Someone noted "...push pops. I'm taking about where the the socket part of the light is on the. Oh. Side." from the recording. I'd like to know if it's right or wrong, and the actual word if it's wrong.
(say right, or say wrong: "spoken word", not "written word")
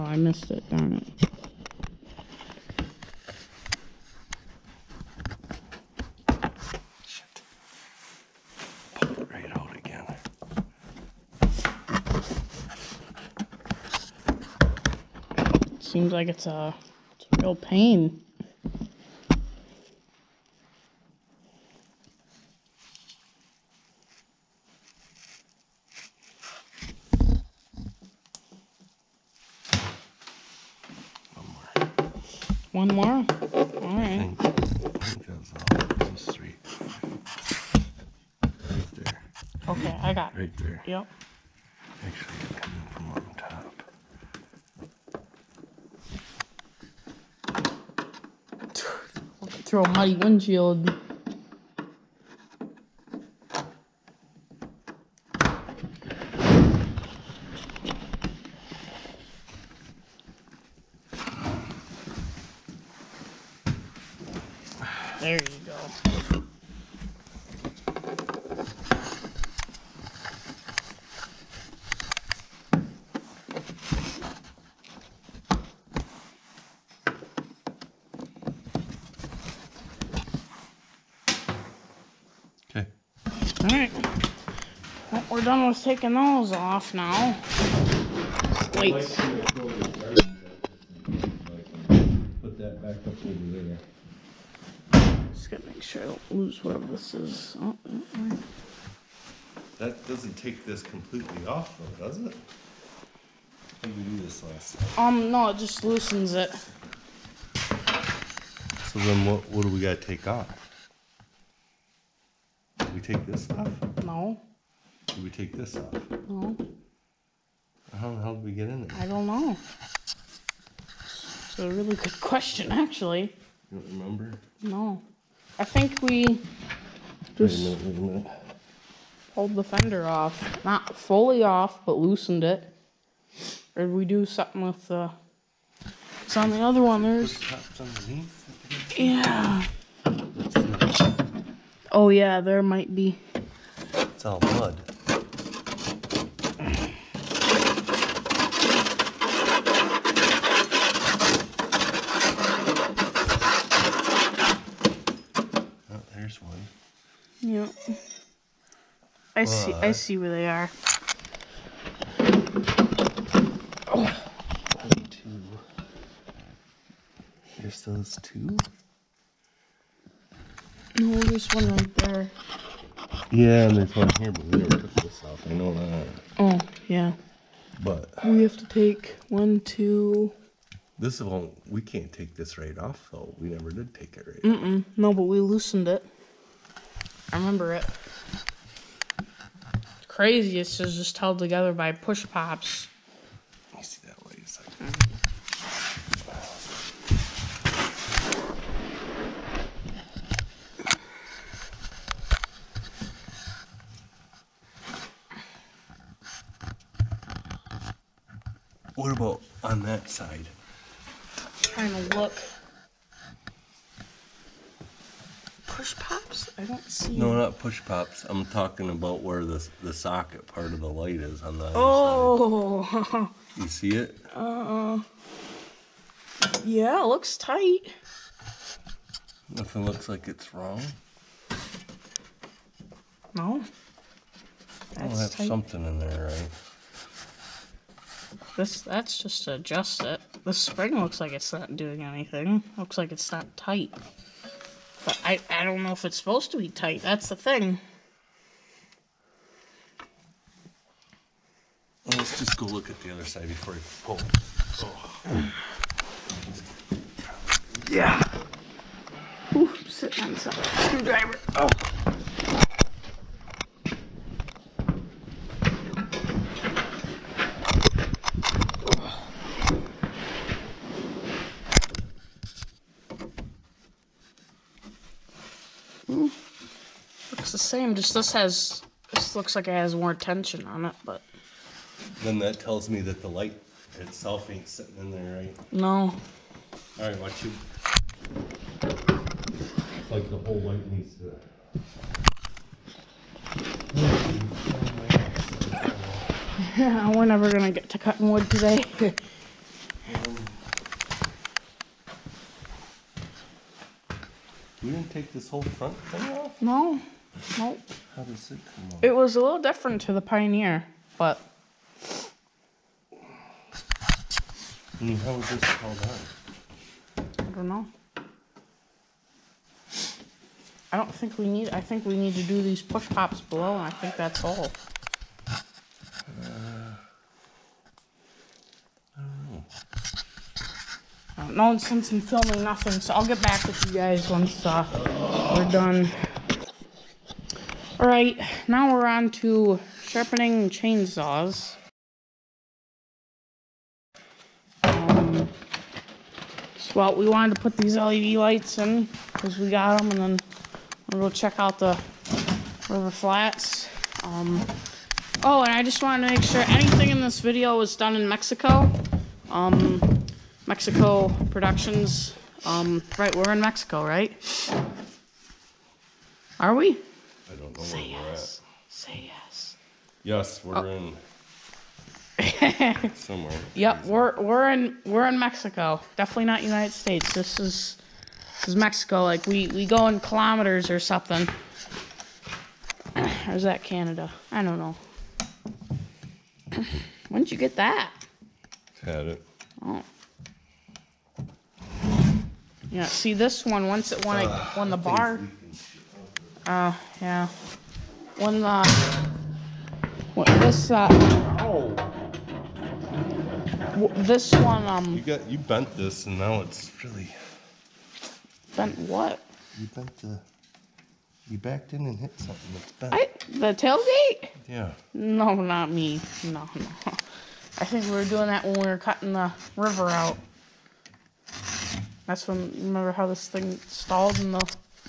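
wrong: "talking", not "taking".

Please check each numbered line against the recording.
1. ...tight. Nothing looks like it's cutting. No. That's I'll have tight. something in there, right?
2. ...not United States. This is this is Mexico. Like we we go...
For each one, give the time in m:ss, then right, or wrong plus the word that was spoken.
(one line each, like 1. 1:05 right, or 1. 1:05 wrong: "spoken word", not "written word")
1. 3:47 wrong: "wrong", not "cutting"
2. 6:16 right.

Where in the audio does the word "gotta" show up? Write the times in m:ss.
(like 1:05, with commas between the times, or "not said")
1:35, 1:49.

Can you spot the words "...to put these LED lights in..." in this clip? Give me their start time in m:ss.
5:47.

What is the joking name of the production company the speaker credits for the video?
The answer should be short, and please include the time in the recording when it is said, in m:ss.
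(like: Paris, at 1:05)
Mexico Productions, at 6:00.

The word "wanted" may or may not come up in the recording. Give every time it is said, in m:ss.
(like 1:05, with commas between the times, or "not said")
5:47, 5:56.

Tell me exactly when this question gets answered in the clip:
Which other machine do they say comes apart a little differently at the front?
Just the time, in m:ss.
5:10.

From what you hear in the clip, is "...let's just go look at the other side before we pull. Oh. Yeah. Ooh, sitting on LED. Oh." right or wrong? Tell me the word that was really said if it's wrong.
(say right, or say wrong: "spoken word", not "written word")
wrong: "Screwdriver", not "LED".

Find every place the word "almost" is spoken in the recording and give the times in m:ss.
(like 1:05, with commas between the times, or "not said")
1:25.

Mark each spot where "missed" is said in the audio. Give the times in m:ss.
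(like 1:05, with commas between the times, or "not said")
0:00.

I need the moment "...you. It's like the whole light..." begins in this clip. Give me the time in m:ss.
4:47.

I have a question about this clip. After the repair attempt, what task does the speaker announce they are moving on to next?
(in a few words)
sharpening chainsaws.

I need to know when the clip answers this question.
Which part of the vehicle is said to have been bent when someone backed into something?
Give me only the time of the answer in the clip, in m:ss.
6:53.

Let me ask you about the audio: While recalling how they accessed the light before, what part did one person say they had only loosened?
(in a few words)
the fender.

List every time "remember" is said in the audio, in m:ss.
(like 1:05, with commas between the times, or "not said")
2:03, 3:07, 7:02.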